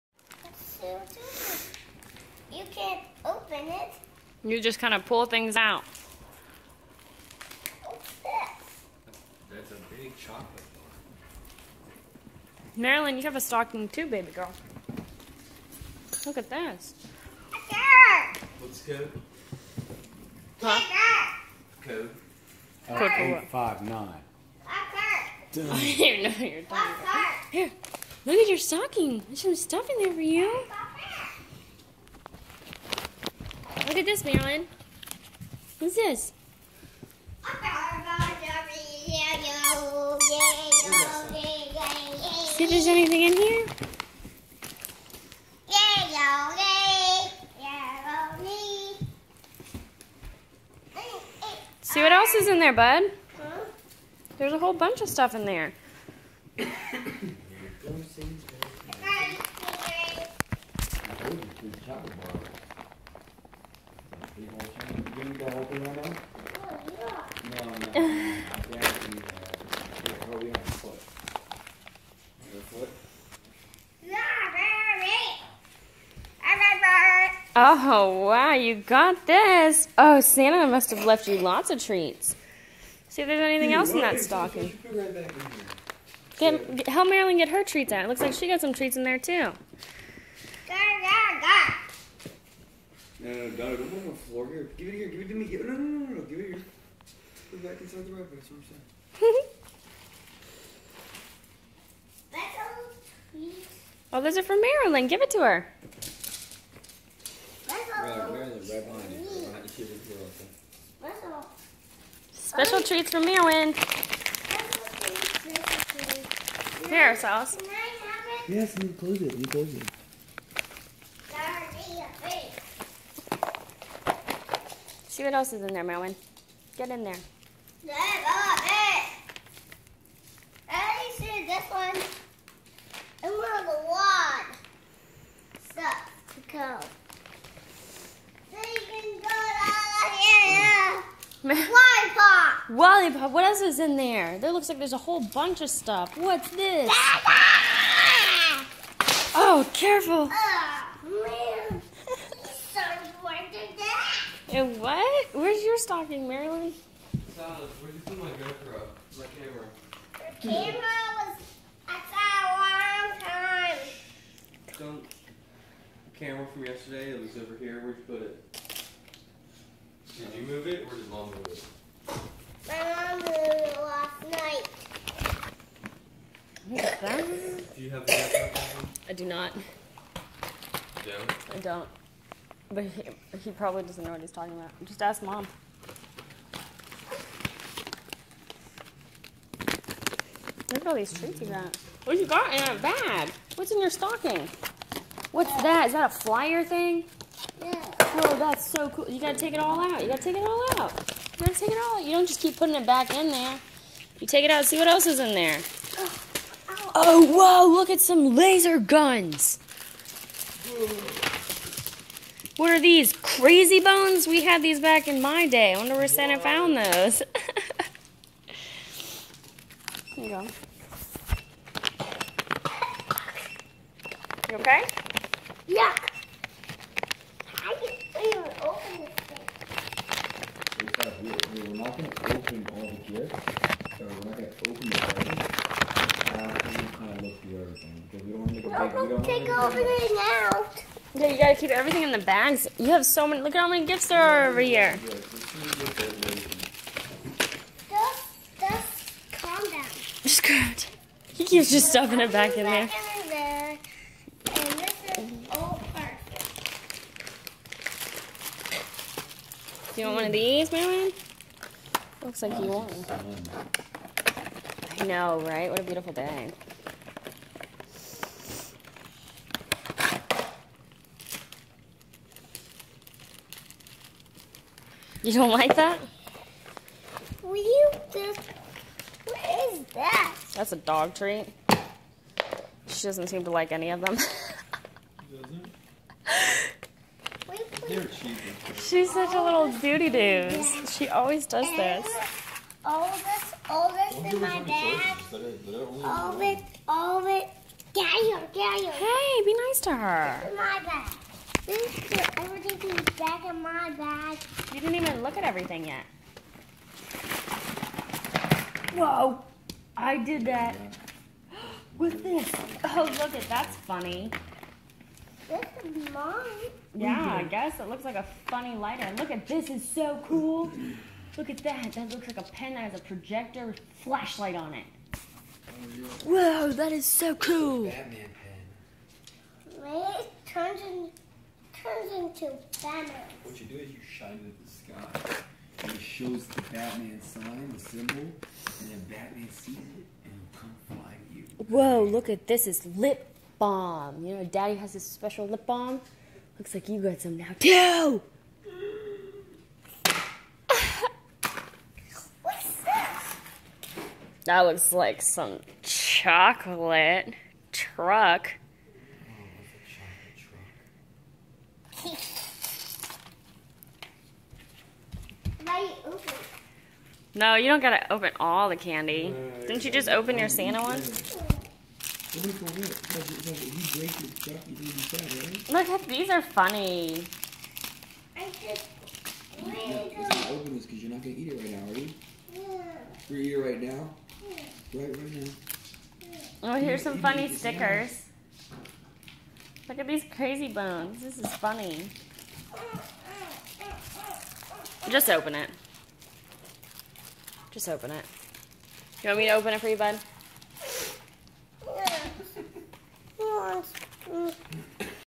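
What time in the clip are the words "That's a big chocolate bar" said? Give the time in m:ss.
0:09.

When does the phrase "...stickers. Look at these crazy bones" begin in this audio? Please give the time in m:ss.
6:27.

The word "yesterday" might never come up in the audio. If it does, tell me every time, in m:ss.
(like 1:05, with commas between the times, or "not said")
2:46.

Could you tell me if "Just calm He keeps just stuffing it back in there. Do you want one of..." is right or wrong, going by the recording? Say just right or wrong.
right.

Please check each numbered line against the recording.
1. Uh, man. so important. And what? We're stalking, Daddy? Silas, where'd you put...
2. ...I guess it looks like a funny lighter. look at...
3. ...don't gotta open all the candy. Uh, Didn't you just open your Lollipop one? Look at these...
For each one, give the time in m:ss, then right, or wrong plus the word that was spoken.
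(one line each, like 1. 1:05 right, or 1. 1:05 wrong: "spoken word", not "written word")
1. 2:30 wrong: "Marilyn", not "Daddy"
2. 5:17 right
3. 6:07 wrong: "Santa", not "Lollipop".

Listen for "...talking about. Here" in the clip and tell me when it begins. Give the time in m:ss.
0:26.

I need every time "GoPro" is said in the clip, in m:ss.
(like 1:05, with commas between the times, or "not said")
2:38, 2:58.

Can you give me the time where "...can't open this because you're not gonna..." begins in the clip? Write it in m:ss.
6:19.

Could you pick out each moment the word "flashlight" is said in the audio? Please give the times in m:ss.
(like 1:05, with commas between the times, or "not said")
5:24.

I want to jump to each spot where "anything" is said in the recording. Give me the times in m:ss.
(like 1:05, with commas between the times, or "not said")
0:42, 1:23.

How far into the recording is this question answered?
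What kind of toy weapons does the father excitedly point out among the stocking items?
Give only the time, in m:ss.
3:28.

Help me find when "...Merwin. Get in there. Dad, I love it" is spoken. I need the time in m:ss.
2:05.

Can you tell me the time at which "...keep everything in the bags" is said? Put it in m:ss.
4:01.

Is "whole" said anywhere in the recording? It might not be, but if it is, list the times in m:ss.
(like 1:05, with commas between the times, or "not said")
0:54, 2:24.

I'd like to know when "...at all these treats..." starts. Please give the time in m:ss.
3:10.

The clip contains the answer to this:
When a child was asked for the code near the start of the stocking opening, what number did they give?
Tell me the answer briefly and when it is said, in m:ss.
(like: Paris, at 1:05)
859, at 0:23.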